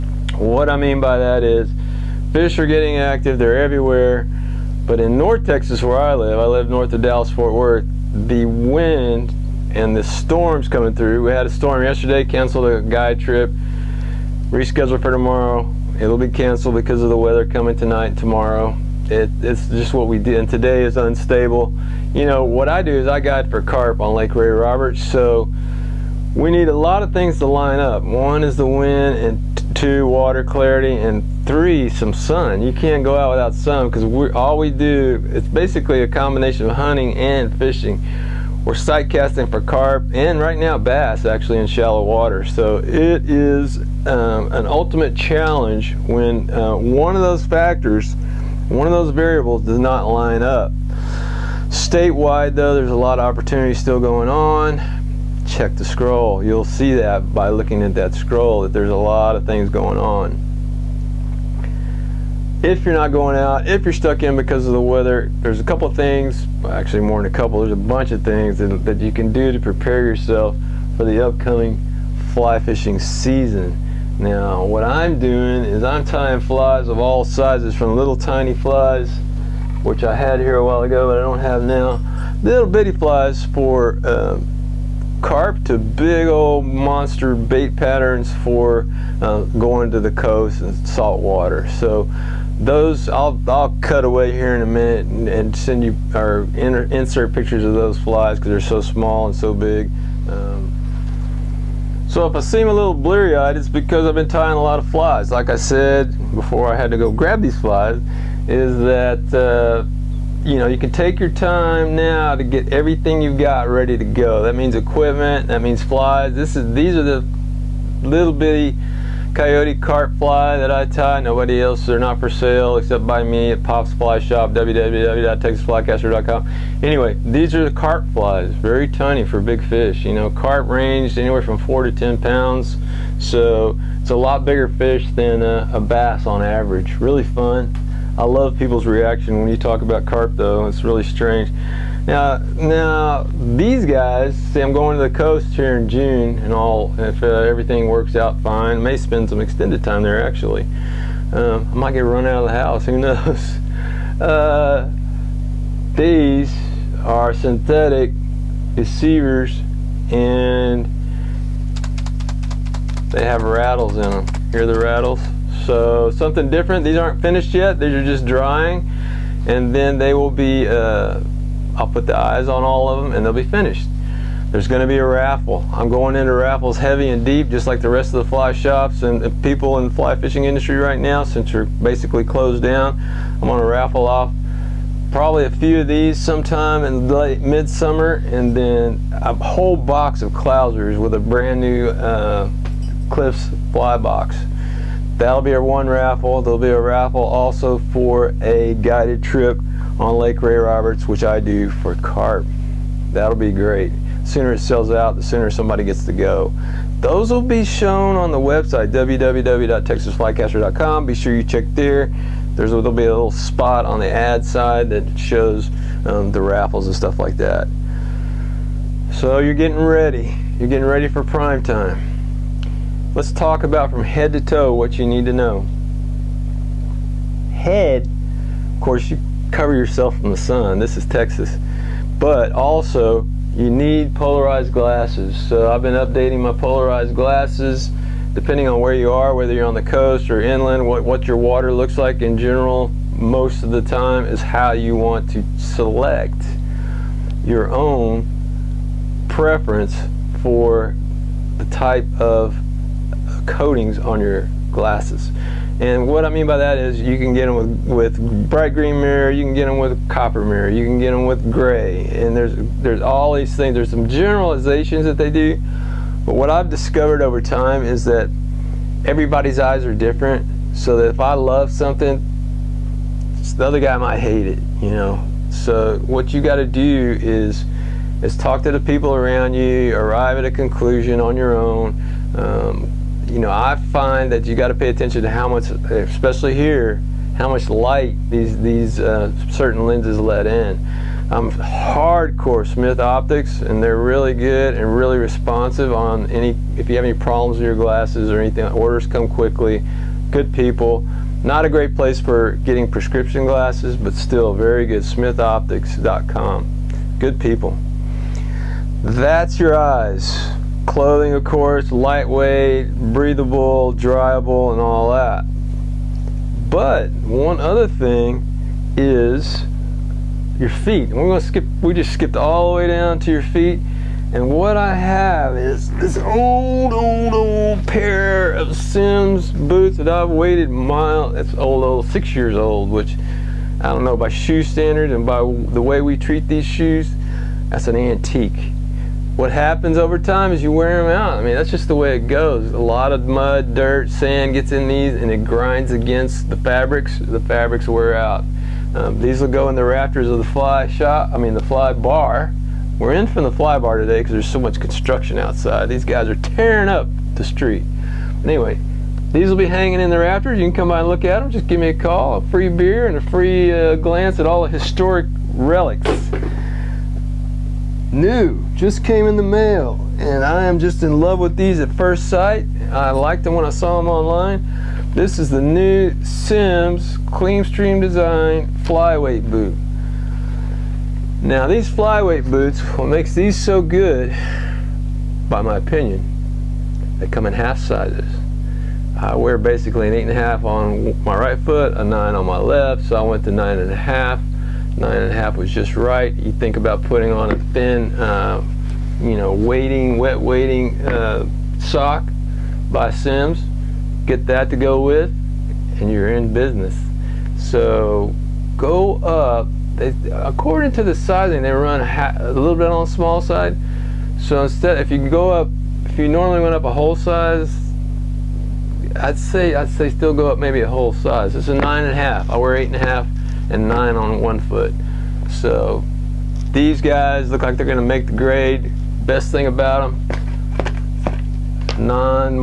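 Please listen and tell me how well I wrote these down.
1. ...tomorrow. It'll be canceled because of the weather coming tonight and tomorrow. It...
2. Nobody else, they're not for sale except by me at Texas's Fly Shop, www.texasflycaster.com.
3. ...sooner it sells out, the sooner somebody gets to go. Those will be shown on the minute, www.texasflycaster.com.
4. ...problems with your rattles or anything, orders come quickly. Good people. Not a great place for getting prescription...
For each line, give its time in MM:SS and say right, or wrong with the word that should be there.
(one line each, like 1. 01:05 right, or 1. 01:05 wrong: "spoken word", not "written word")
1. 00:15 right
2. 02:01 wrong: "Pop", not "Texas"
3. 03:24 wrong: "website", not "minute"
4. 04:57 wrong: "glasses", not "rattles".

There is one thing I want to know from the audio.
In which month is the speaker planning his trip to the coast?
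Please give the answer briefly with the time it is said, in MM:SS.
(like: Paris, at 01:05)
June, at 02:25.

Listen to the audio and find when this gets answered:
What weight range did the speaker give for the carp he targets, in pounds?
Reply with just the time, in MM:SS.
02:11.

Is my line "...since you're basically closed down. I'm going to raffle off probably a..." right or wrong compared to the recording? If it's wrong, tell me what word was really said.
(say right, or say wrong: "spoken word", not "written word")
right.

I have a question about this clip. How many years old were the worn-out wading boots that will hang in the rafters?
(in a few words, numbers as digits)
6.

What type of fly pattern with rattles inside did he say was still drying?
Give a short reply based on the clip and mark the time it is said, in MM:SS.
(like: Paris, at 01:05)
Synthetic deceivers, at 02:37.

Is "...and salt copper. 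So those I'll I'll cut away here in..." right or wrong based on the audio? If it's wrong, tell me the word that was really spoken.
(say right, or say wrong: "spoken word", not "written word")
wrong: "water", not "copper".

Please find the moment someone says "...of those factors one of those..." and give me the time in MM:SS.
00:47.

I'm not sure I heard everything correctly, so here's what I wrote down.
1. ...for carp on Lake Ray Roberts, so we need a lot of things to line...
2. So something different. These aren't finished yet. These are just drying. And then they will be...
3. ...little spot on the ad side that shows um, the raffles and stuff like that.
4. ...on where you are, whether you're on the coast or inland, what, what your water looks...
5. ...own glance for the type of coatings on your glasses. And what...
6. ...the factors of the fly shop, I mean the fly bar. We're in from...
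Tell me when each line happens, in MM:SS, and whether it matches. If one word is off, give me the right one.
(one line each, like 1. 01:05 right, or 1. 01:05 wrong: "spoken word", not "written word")
1. 00:23 right
2. 02:45 right
3. 03:33 right
4. 03:58 right
5. 04:07 wrong: "preference", not "glance"
6. 05:49 wrong: "rafters", not "factors".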